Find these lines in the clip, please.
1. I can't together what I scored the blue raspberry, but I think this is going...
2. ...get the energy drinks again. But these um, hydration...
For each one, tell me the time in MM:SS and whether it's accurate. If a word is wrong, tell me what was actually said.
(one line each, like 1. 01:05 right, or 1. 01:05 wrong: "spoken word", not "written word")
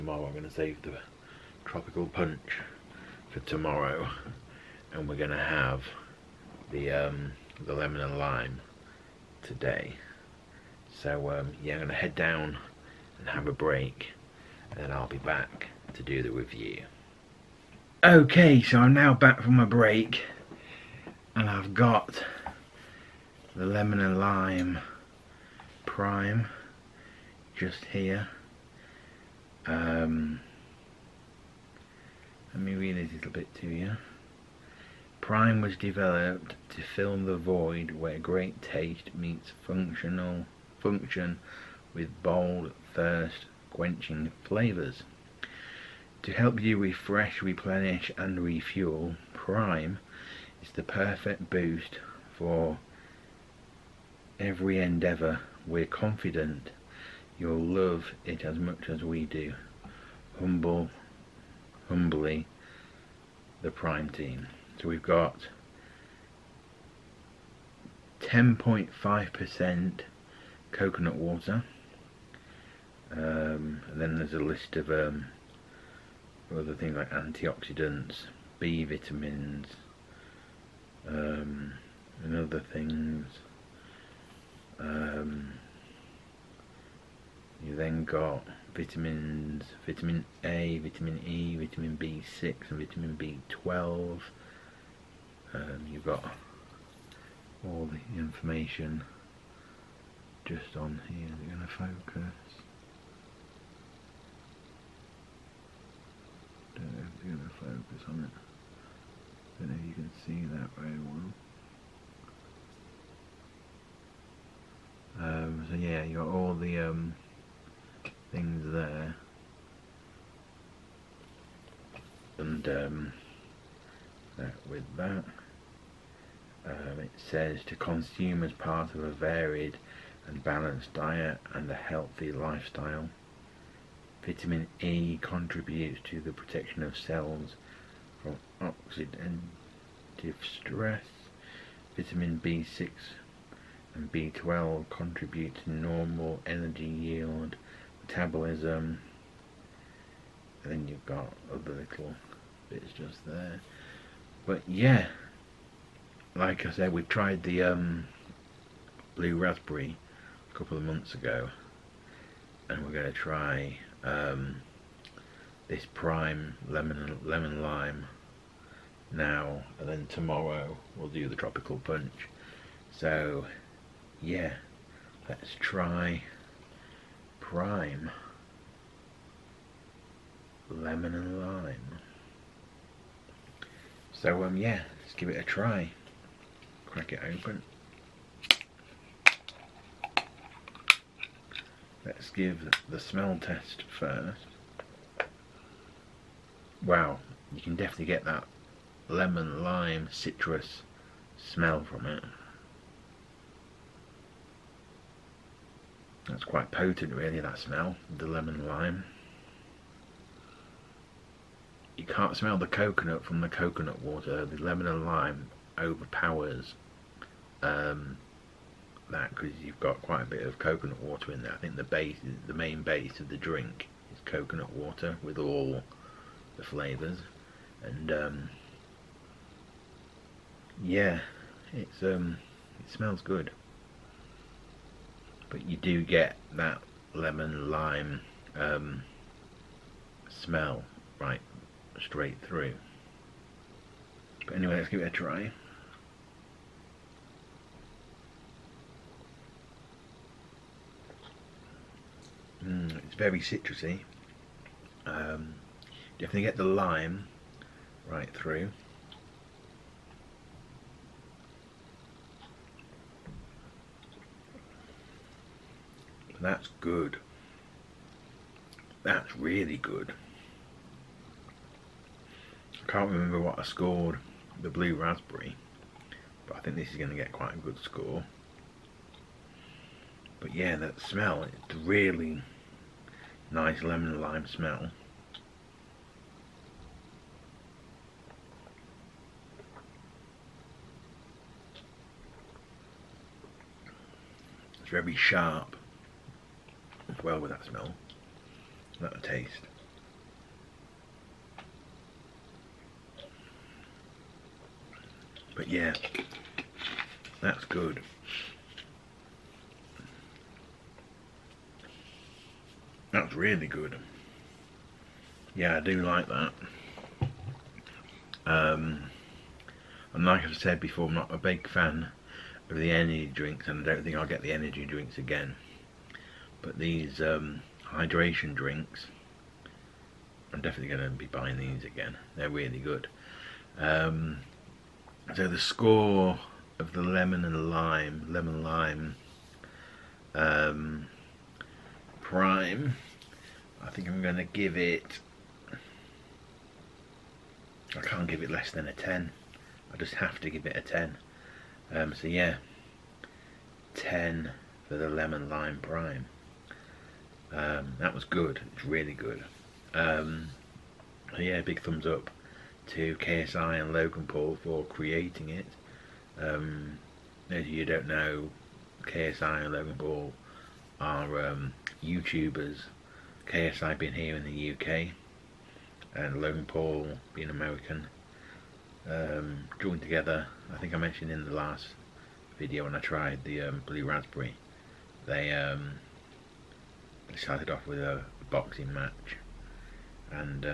1. 04:32 wrong: "remember", not "together"
2. 05:24 right.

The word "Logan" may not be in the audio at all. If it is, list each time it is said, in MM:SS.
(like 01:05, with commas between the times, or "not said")
06:03, 06:09, 06:16.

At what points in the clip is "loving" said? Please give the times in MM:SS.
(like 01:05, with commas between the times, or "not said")
not said.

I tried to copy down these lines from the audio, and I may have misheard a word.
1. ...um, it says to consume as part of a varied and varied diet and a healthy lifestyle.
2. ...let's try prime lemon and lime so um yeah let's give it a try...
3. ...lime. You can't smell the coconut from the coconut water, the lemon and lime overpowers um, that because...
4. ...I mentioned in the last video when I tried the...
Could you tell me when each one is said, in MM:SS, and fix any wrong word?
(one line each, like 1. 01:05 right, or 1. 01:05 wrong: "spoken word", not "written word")
1. 02:06 wrong: "balanced", not "varied"
2. 02:55 right
3. 03:28 right
4. 06:20 right.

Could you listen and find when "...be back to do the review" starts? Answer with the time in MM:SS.
00:15.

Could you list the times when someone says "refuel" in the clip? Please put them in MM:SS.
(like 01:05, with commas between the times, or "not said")
00:48.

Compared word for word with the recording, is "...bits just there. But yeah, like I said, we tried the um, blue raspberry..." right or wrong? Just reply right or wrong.
right.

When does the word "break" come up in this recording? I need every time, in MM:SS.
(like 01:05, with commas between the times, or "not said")
00:13, 00:19.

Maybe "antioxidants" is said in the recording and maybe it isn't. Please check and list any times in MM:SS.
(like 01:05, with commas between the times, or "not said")
01:17.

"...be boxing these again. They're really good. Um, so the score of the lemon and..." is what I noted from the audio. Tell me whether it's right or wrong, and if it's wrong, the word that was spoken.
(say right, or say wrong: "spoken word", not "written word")
wrong: "buying", not "boxing".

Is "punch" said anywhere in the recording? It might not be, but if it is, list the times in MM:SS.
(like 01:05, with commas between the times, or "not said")
00:02, 02:51.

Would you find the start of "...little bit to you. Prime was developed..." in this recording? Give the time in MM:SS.
00:33.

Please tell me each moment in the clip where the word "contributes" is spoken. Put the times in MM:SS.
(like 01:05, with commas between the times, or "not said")
02:15, 02:24.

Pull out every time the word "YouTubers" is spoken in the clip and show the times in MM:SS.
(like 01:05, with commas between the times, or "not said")
06:12.